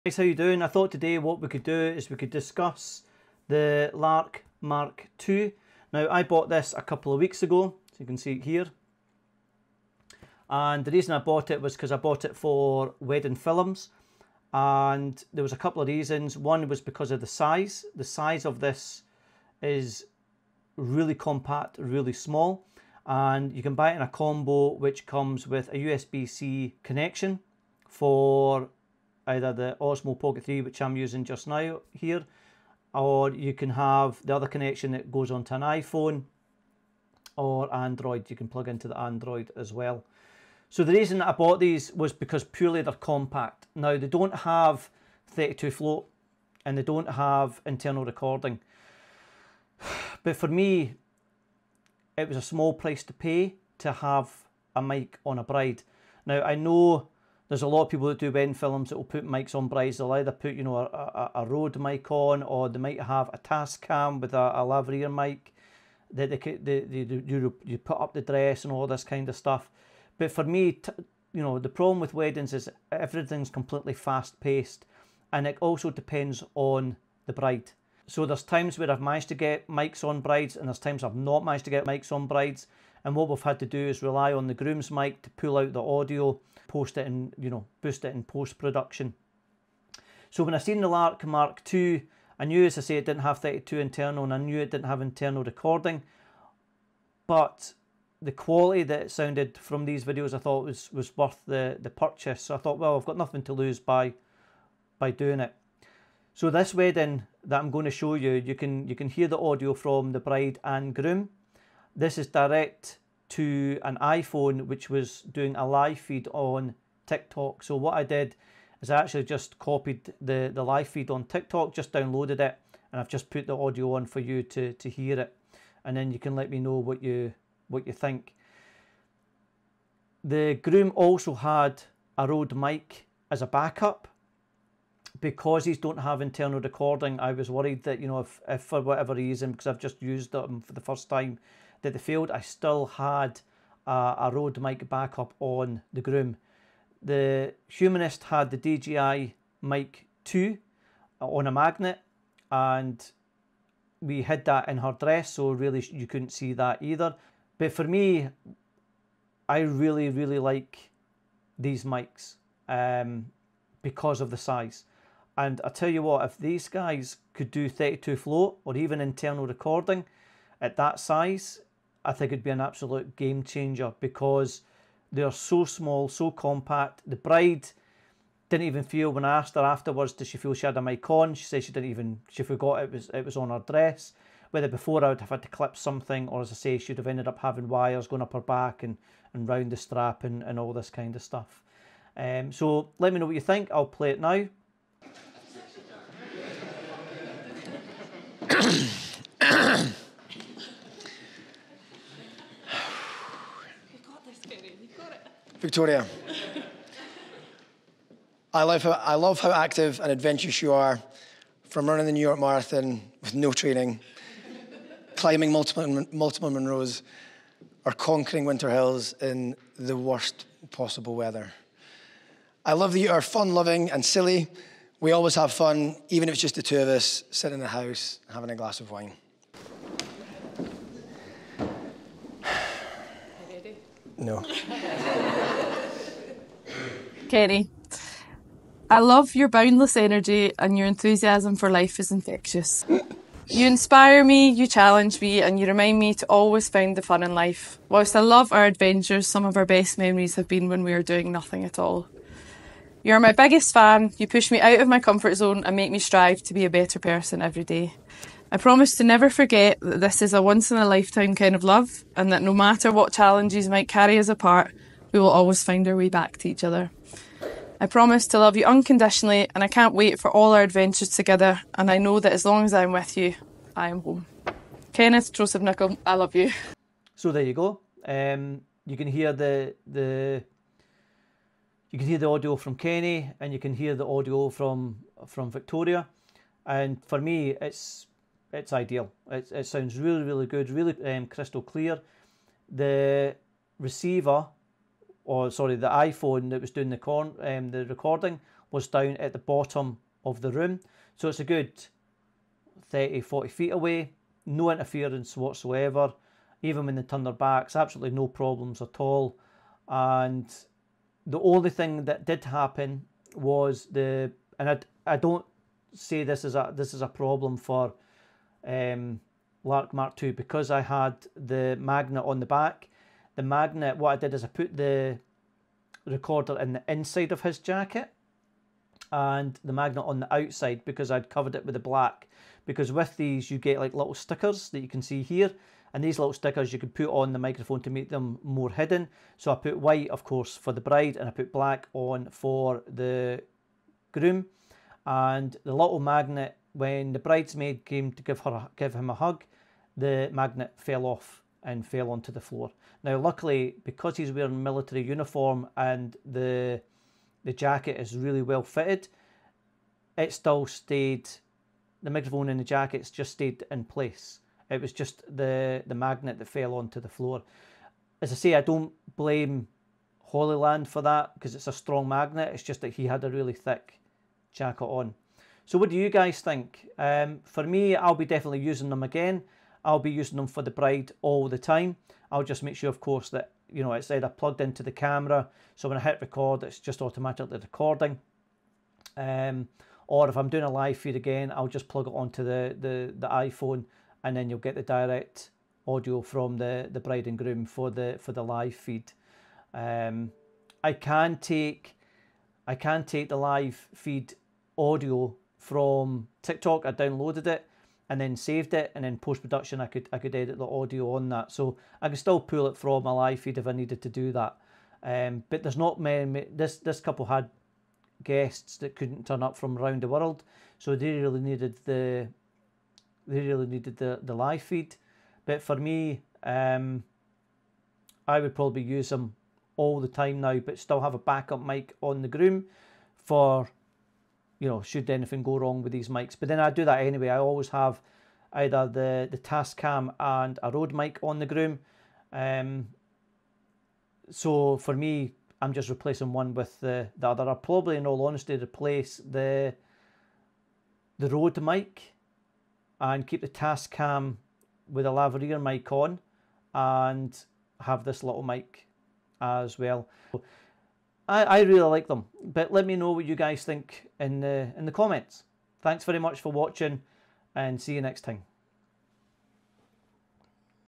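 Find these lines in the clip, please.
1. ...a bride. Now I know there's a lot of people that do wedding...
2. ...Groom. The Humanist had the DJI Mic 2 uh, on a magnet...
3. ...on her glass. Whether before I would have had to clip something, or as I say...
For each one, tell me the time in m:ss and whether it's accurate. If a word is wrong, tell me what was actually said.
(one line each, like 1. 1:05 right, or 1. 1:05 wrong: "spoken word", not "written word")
1. 0:55 right
2. 2:26 right
3. 3:03 wrong: "dress", not "glass".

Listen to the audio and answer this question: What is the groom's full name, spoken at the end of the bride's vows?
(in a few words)
Kenneth Joseph Nichol.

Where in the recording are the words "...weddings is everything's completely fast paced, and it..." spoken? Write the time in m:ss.
1:12.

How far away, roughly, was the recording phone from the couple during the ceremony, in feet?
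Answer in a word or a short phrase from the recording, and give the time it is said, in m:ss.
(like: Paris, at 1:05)
30 to 40 feet, at 5:02.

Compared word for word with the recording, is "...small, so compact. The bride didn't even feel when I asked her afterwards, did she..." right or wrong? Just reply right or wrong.
right.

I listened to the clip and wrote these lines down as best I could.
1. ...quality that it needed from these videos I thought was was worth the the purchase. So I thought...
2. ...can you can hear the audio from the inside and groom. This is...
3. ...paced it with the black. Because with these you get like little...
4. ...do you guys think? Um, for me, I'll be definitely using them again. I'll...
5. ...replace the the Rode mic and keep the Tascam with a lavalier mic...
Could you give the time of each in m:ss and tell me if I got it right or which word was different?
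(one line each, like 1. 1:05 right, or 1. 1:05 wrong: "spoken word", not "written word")
1. 1:38 wrong: "sounded", not "needed"
2. 1:48 wrong: "bride", not "inside"
3. 5:31 wrong: "covered", not "paced"
4. 6:15 right
5. 7:28 right.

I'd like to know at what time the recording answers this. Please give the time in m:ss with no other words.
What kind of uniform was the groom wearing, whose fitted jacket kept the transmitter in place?
5:54.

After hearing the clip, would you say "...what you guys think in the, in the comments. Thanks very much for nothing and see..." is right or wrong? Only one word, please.
wrong.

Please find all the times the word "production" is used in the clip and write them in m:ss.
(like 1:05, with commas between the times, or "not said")
1:28, 6:49.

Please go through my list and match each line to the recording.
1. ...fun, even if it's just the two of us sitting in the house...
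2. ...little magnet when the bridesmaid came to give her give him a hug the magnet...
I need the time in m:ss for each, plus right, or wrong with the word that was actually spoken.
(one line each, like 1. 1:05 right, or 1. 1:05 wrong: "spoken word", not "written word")
1. 3:45 right
2. 5:45 right.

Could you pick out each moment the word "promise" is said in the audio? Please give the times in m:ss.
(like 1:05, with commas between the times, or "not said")
4:18, 4:27.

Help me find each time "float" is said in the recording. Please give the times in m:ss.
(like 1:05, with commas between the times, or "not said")
0:45, 2:48.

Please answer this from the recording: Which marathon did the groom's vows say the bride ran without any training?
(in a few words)
New York Marathon.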